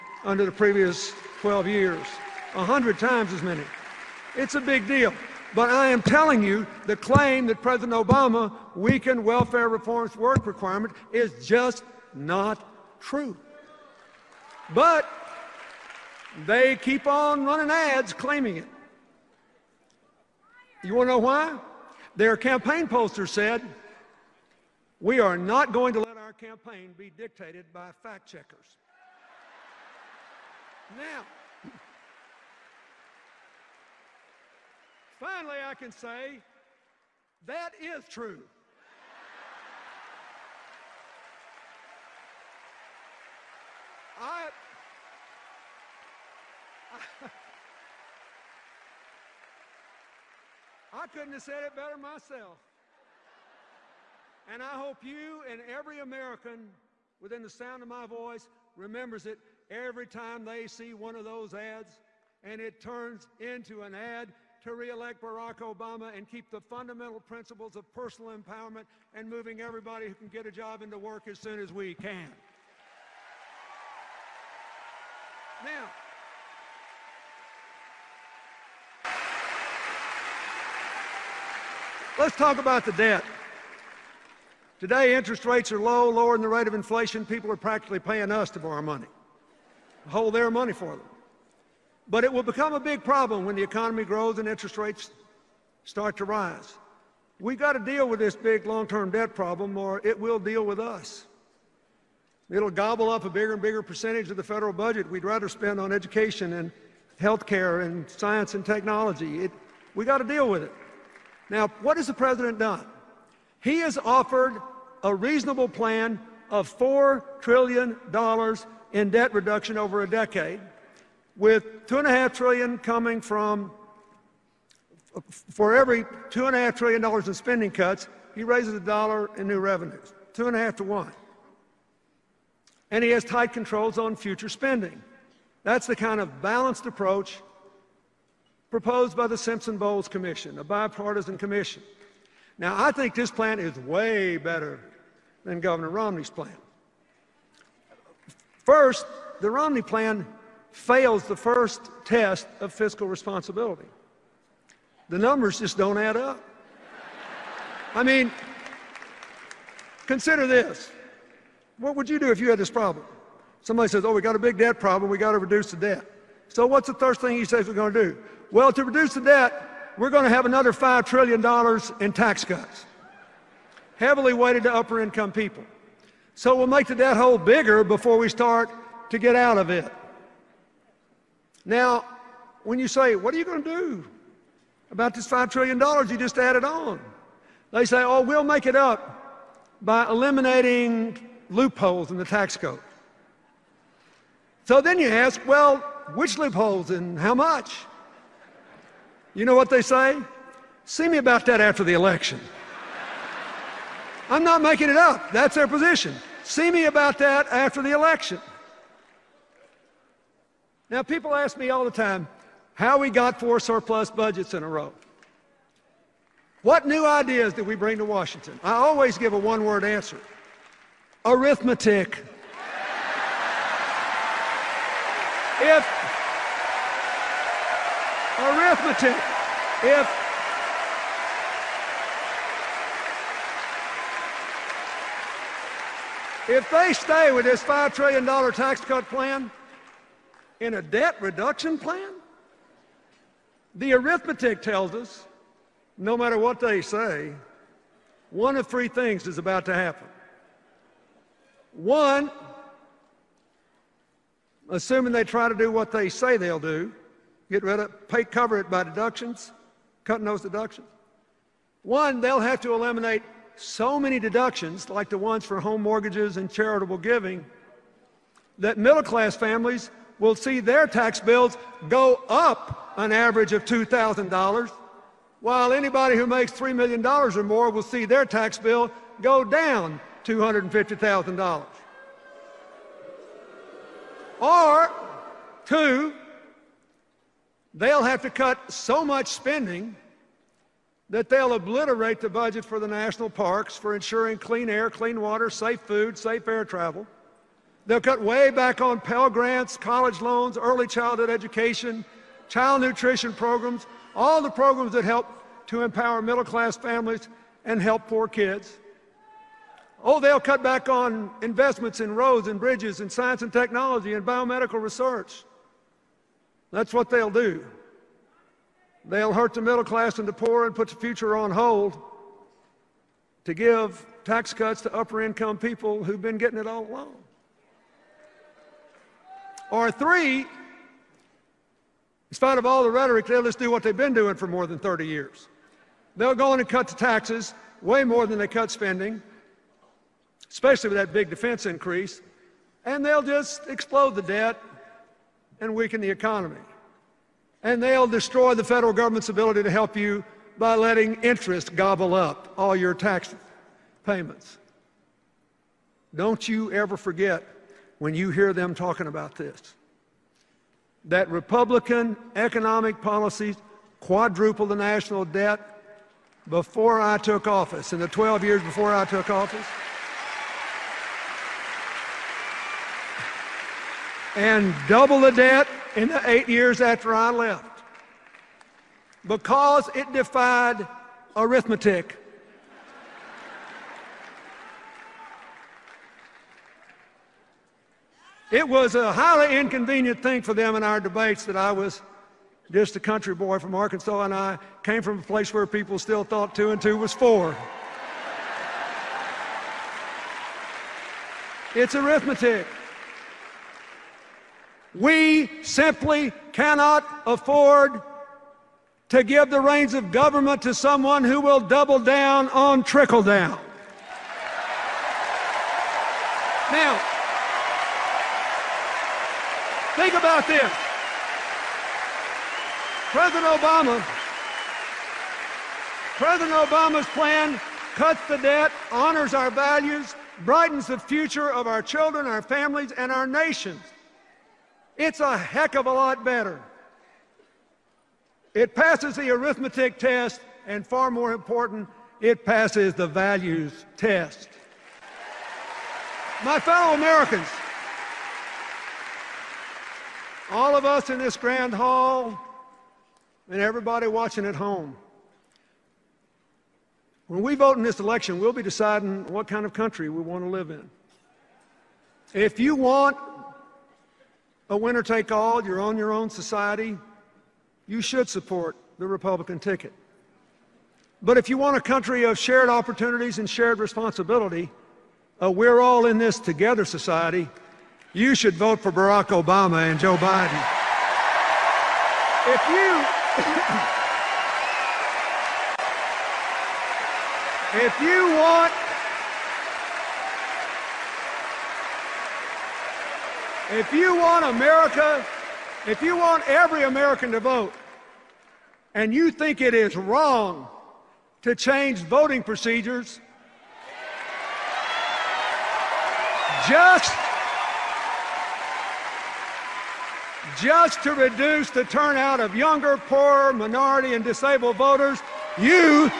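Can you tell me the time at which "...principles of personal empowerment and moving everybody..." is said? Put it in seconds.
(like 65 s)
67 s.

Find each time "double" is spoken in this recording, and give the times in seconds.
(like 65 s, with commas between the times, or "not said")
374 s, 411 s.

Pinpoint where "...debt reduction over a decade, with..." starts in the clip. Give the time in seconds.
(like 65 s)
119 s.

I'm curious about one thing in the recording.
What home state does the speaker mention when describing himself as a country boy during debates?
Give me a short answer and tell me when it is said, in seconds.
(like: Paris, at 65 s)
Arkansas, at 393 s.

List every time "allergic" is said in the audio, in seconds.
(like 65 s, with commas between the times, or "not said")
not said.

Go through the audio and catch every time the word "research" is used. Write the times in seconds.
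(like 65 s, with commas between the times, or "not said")
314 s.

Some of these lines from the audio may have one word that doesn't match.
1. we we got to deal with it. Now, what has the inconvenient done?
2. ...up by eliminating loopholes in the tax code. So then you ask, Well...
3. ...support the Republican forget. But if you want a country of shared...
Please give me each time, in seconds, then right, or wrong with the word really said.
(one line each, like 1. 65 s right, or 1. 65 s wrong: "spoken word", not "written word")
1. 109 s wrong: "president", not "inconvenient"
2. 188 s right
3. 468 s wrong: "ticket", not "forget".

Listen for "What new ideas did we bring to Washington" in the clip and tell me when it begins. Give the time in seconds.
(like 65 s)
216 s.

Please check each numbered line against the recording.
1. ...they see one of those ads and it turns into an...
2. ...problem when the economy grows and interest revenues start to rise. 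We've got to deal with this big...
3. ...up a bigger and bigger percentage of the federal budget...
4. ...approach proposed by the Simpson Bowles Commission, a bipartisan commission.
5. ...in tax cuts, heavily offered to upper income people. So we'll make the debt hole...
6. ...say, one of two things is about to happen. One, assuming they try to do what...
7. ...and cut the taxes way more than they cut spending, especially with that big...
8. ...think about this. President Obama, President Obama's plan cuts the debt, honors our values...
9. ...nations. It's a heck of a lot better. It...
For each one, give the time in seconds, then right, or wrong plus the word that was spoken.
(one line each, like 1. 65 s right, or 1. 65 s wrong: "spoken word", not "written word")
1. 60 s right
2. 93 s wrong: "rates", not "revenues"
3. 103 s right
4. 136 s right
5. 171 s wrong: "weighted", not "offered"
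6. 246 s wrong: "three", not "two"
7. 336 s right
8. 419 s right
9. 433 s right.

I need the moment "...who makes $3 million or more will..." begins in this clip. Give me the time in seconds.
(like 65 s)
276 s.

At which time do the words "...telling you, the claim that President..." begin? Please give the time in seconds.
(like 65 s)
6 s.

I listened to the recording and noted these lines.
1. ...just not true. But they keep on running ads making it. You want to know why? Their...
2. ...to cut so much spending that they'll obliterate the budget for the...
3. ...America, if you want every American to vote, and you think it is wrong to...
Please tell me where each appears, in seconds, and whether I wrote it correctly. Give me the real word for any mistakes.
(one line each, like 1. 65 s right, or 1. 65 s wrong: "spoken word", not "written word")
1. 11 s wrong: "claiming", not "making"
2. 288 s right
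3. 494 s right.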